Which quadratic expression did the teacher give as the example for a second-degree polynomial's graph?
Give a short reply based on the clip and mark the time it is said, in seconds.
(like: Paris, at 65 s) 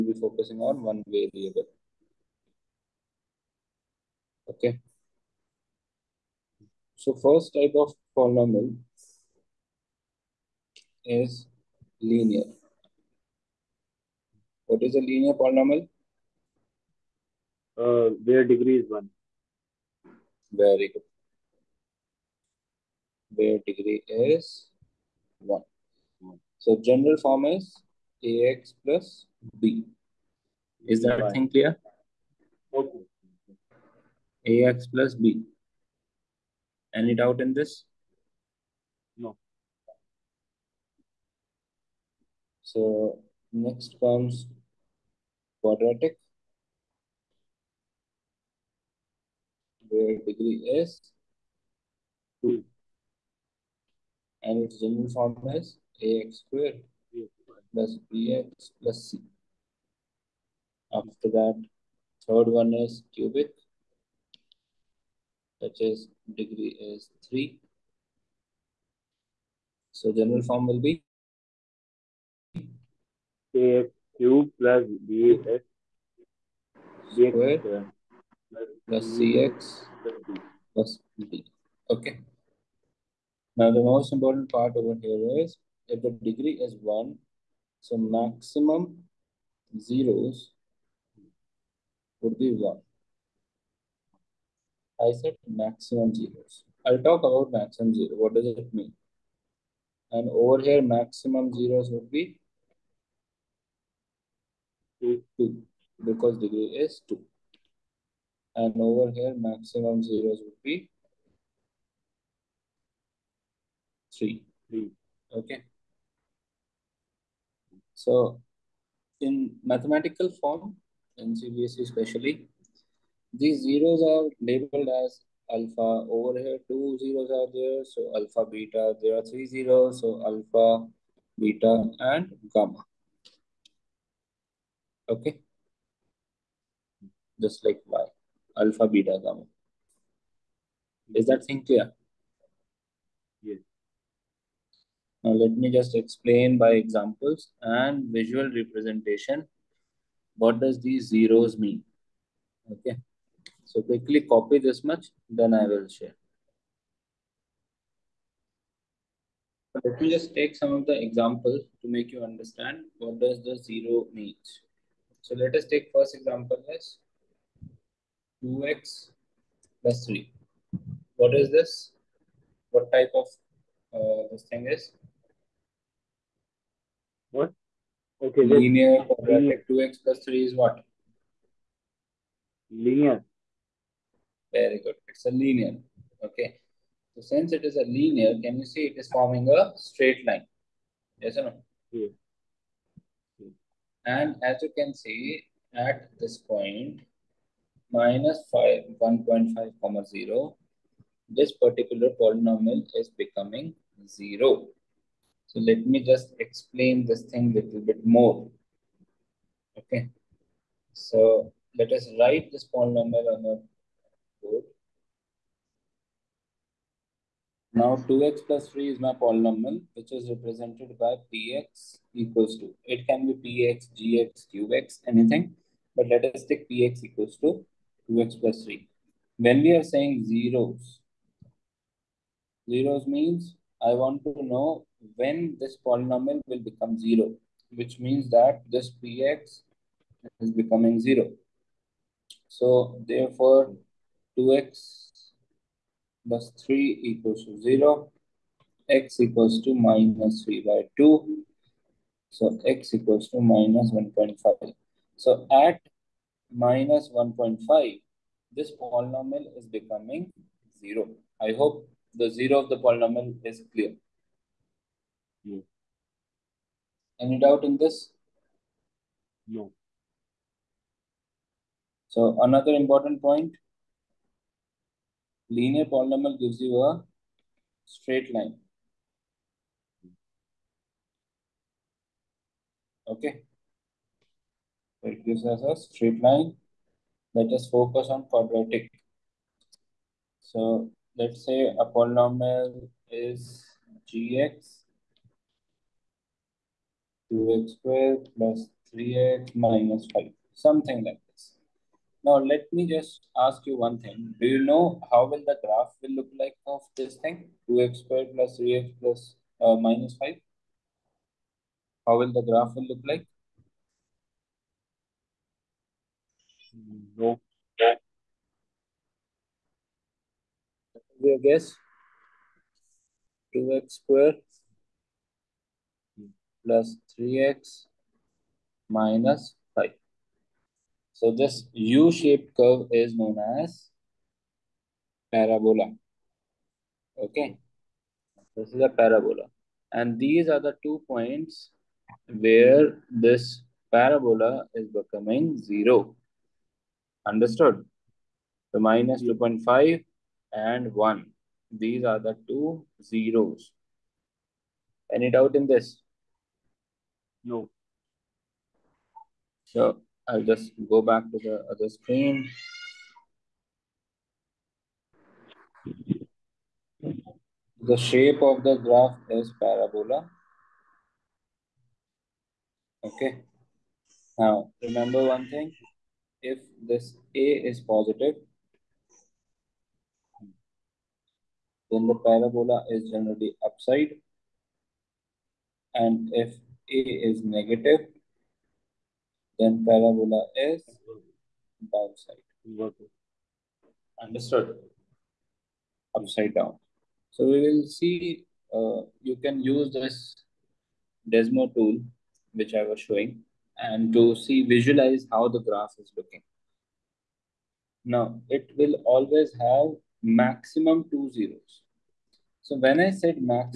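2x² + 3x - 5, at 297 s.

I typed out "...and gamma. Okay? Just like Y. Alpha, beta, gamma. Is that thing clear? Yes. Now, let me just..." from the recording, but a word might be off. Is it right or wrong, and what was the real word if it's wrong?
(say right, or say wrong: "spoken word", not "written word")
right.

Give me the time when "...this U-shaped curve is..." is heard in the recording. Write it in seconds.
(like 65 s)
331 s.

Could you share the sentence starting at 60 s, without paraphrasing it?
After that, third one is cubic, which is degree is 3.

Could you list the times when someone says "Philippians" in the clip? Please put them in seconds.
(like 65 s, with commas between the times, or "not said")
not said.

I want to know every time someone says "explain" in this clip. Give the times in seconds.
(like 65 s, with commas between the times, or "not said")
145 s, 206 s.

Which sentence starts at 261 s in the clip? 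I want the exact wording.
I hope the 0 of the polynomial is clear.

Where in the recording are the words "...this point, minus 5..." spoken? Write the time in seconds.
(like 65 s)
196 s.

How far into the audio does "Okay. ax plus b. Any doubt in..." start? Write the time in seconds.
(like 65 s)
32 s.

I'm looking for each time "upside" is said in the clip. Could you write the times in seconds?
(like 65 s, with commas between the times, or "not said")
383 s, 396 s.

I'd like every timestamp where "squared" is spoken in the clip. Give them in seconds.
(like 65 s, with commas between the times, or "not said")
56 s, 297 s, 308 s, 324 s.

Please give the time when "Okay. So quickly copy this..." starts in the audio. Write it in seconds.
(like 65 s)
152 s.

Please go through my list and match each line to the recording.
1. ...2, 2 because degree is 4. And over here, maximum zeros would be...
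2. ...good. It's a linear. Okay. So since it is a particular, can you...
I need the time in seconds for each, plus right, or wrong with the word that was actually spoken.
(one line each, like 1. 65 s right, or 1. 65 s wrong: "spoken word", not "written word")
1. 105 s wrong: "2", not "4"
2. 184 s wrong: "linear", not "particular".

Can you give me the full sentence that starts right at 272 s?
So another important point, linear polynomial gives you a straight line.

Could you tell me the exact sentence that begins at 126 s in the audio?
Over here, two zeros are there, so alpha, beta.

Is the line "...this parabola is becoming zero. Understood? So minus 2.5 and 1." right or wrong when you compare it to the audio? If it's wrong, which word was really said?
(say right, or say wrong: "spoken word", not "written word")
right.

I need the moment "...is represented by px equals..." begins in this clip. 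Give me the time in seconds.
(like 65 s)
220 s.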